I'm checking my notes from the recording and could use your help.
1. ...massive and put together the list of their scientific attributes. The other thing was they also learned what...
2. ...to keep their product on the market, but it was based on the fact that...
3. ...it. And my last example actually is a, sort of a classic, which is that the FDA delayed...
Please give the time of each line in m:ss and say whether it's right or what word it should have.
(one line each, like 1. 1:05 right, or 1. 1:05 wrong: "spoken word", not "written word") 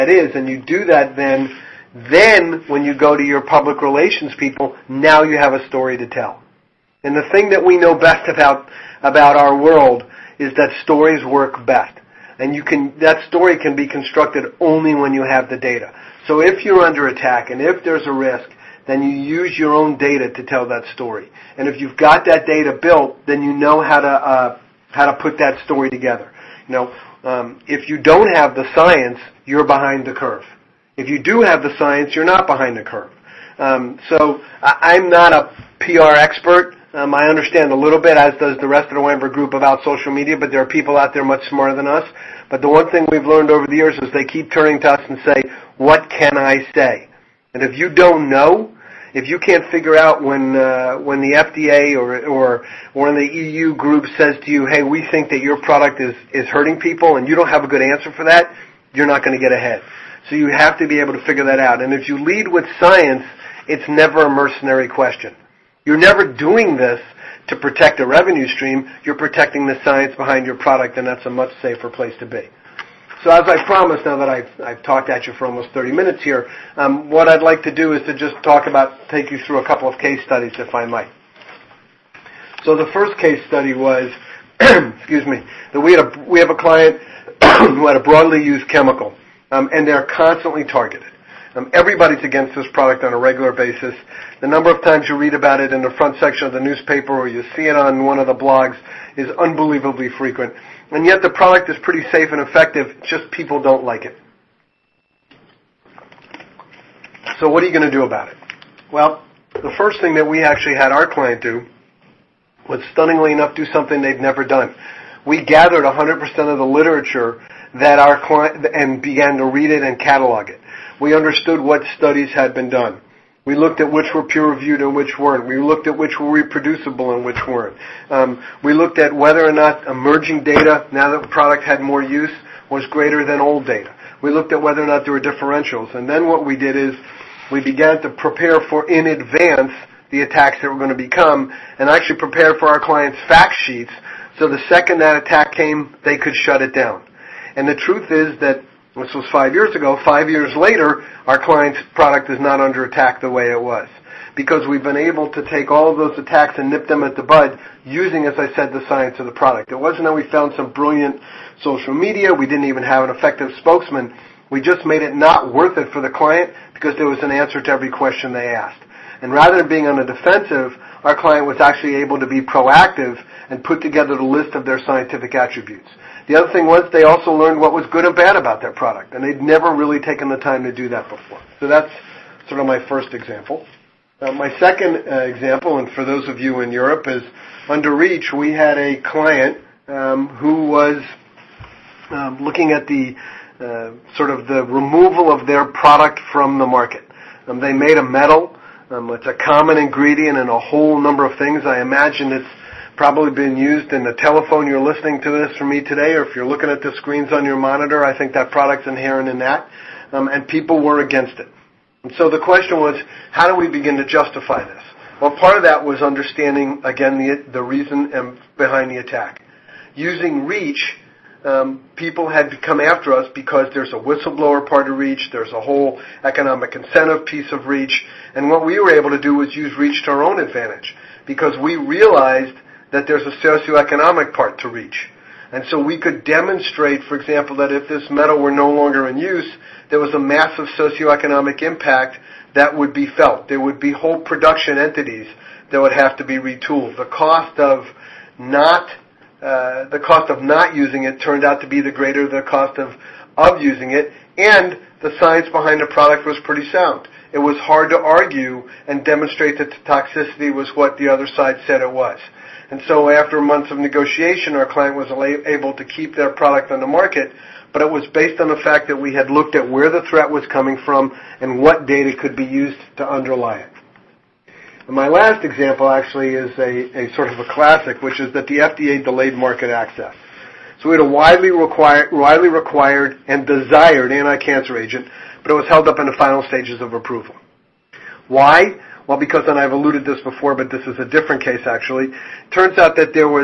1. 2:52 wrong: "proactive", not "massive"
2. 4:25 right
3. 4:33 right.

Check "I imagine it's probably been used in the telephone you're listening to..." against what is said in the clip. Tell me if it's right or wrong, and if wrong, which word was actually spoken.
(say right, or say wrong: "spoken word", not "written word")
right.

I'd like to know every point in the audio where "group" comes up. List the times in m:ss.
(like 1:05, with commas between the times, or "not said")
0:39, 0:53.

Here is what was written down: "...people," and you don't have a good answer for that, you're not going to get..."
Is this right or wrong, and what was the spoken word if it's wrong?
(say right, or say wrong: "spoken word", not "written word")
right.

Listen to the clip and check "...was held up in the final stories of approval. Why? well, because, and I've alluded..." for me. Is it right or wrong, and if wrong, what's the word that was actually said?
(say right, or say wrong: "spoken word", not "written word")
wrong: "stages", not "stories".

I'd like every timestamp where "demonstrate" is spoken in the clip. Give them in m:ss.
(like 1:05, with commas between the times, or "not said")
3:56, 4:19.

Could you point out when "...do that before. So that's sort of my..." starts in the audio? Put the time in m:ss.
3:00.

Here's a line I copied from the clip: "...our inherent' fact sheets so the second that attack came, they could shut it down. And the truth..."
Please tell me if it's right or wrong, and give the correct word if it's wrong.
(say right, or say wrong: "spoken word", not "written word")
wrong: "clients", not "inherent".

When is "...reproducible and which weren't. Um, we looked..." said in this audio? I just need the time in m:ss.
2:06.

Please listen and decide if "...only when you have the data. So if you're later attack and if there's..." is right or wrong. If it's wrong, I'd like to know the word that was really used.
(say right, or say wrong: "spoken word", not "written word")
wrong: "under", not "later".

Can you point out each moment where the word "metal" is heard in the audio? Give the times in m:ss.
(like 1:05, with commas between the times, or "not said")
3:18, 3:58.